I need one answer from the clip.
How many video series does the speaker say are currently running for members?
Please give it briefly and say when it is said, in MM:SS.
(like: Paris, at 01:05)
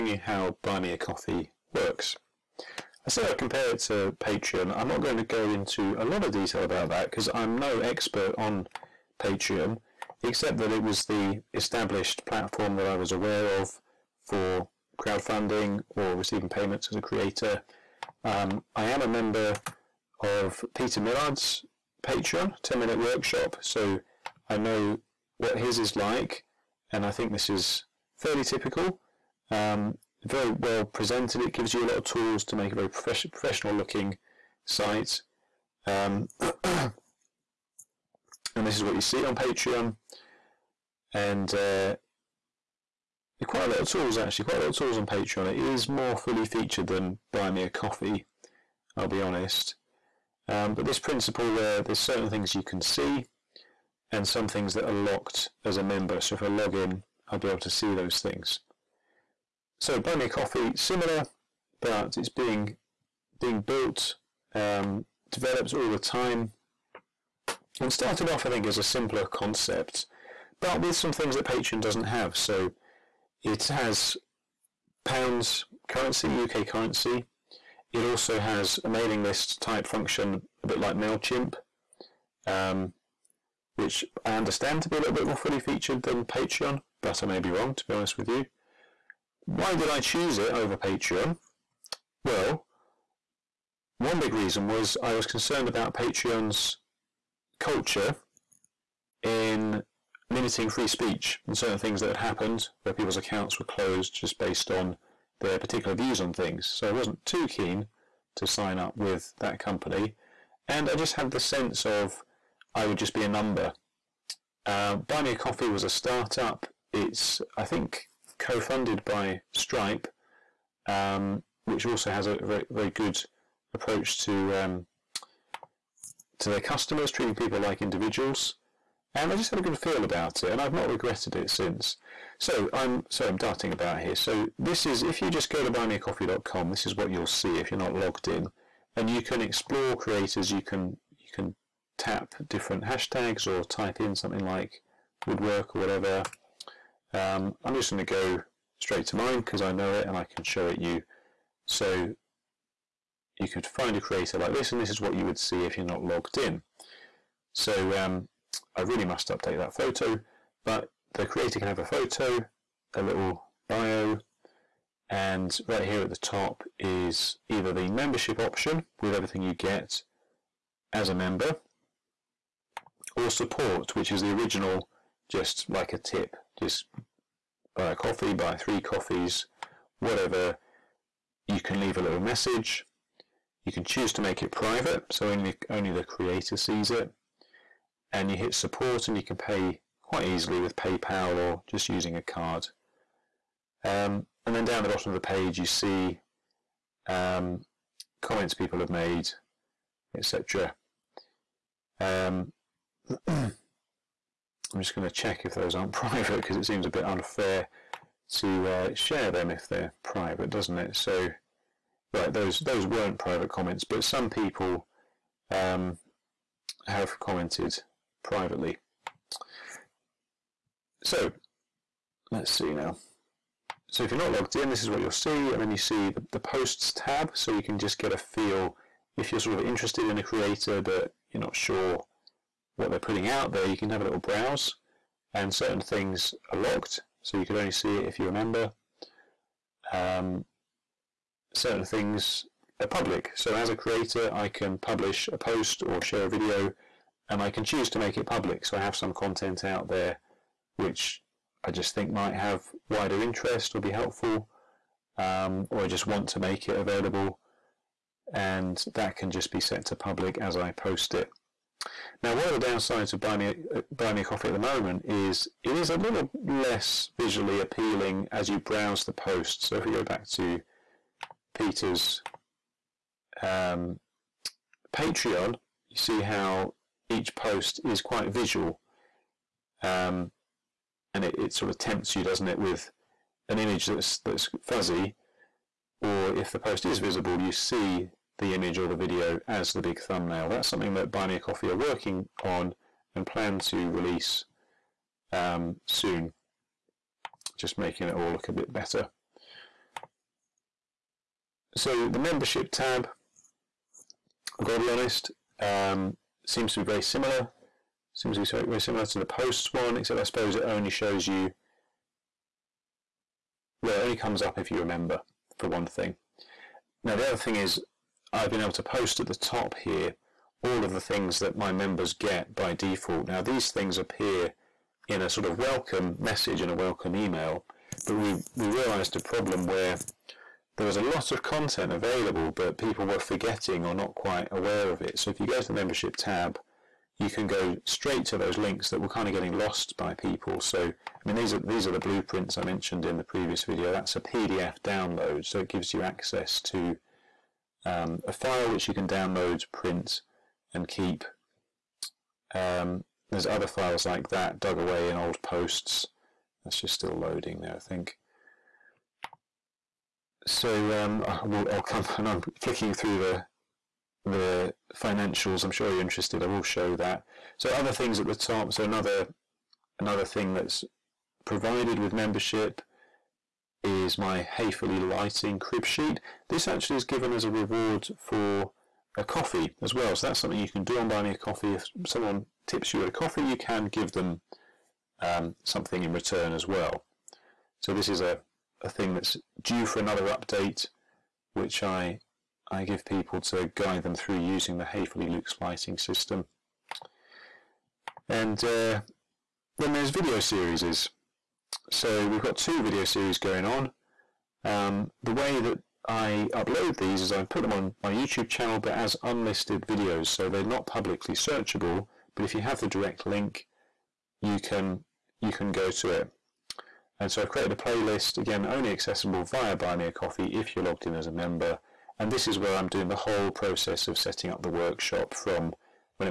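2, at 06:42.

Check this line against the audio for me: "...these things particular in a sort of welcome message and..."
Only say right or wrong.
wrong.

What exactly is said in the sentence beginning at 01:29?
Why did I choose it over Patreon?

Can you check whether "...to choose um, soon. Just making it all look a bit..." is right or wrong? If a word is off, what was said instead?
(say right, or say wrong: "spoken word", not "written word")
wrong: "release", not "choose".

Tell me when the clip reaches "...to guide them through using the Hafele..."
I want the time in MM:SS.
06:33.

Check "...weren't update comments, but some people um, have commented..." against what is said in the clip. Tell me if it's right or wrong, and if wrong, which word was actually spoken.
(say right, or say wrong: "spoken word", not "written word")
wrong: "private", not "update".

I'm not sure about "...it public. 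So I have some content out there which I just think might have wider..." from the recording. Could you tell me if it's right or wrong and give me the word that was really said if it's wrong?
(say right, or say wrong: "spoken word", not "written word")
right.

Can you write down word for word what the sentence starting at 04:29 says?
So if we go back to Peter's um, Patreon, you see how each post is quite visual.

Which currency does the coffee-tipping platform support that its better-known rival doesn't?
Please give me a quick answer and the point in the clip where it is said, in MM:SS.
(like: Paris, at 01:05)
pounds, at 01:15.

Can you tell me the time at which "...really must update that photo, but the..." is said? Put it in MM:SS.
02:38.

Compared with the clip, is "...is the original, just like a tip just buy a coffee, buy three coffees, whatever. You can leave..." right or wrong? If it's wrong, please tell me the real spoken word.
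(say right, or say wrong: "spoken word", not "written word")
right.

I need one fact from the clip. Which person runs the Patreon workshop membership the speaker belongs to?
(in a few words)
Peter Millard.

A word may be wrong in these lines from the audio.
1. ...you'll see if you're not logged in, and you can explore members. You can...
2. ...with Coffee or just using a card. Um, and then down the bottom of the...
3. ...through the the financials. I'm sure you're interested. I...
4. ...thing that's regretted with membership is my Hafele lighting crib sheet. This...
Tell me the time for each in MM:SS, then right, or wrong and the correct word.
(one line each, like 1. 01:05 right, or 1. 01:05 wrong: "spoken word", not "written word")
1. 02:17 wrong: "creators", not "members"
2. 03:10 wrong: "PayPal", not "Coffee"
3. 06:02 right
4. 06:10 wrong: "provided", not "regretted".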